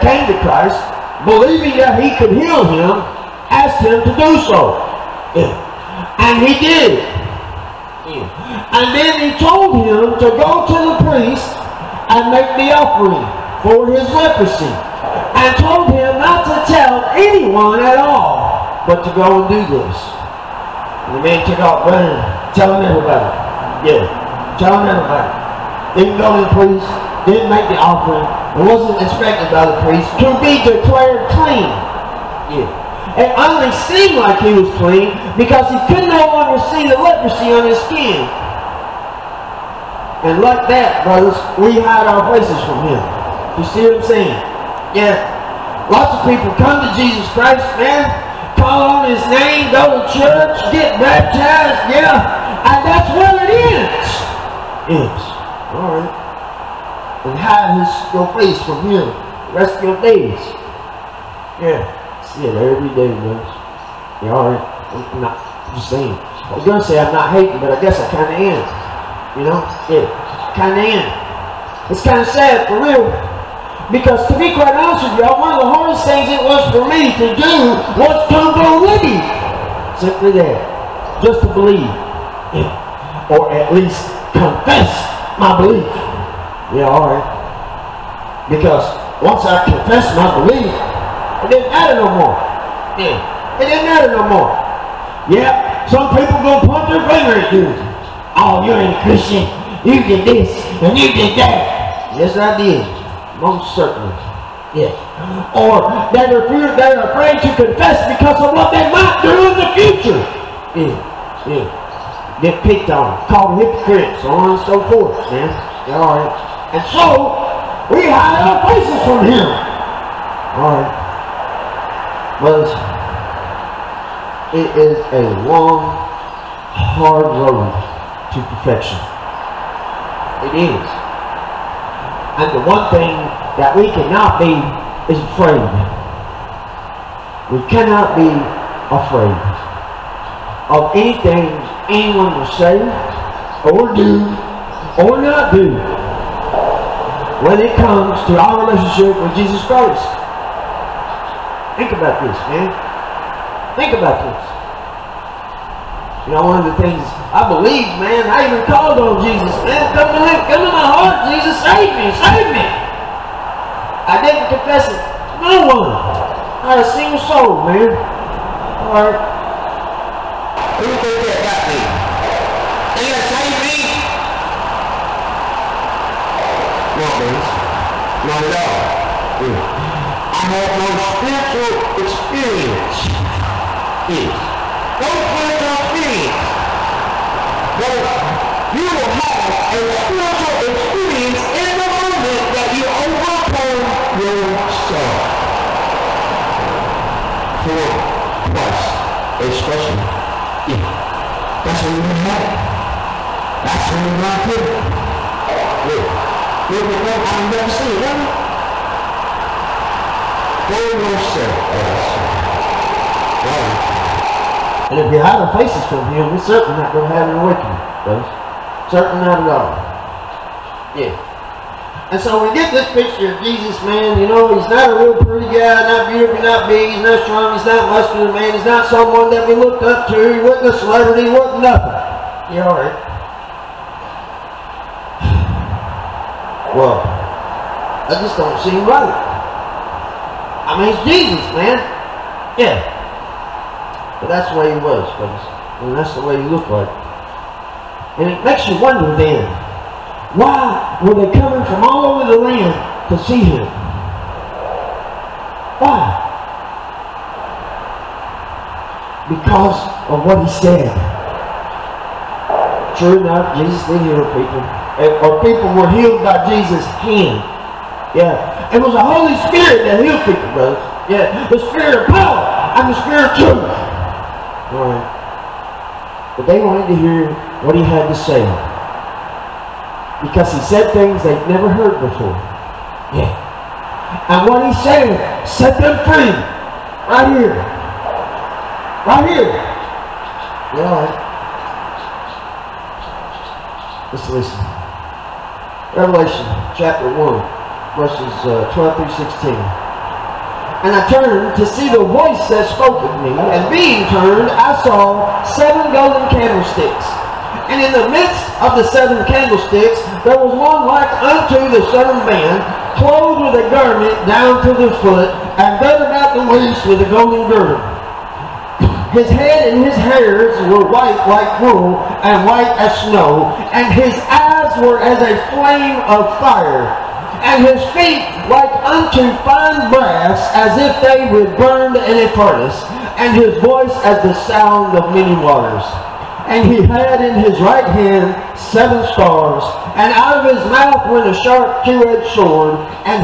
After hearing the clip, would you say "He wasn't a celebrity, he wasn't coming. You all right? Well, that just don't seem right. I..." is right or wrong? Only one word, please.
wrong.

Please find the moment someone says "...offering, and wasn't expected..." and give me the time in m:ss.
0:27.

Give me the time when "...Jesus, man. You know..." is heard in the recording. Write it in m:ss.
3:43.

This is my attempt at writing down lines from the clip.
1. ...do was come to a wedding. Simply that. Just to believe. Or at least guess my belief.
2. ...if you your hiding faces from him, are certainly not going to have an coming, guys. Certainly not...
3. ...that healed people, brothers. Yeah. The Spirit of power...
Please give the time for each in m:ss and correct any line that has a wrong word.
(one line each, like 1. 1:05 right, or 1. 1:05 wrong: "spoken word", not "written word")
1. 1:17 wrong: "confess", not "guess"
2. 3:34 wrong: "awakening", not "coming"
3. 4:29 right.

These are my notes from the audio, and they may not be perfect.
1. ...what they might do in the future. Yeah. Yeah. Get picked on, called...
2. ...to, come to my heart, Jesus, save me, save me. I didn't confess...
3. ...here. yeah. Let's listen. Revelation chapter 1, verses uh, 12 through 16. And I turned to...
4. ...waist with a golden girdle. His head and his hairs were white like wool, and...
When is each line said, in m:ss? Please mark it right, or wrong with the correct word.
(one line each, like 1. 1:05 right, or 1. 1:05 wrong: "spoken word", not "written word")
1. 1:48 right
2. 2:40 right
3. 4:49 right
4. 5:16 right.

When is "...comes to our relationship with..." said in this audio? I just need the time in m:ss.
2:27.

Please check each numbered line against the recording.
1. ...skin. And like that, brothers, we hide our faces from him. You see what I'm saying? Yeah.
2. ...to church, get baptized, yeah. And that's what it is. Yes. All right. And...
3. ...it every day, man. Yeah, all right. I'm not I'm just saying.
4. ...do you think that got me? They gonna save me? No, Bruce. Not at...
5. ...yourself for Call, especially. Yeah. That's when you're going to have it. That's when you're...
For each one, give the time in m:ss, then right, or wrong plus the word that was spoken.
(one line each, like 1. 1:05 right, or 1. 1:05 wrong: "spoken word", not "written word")
1. 0:37 right
2. 0:50 right
3. 1:02 right
4. 2:50 right
5. 3:14 wrong: "Christ", not "Call".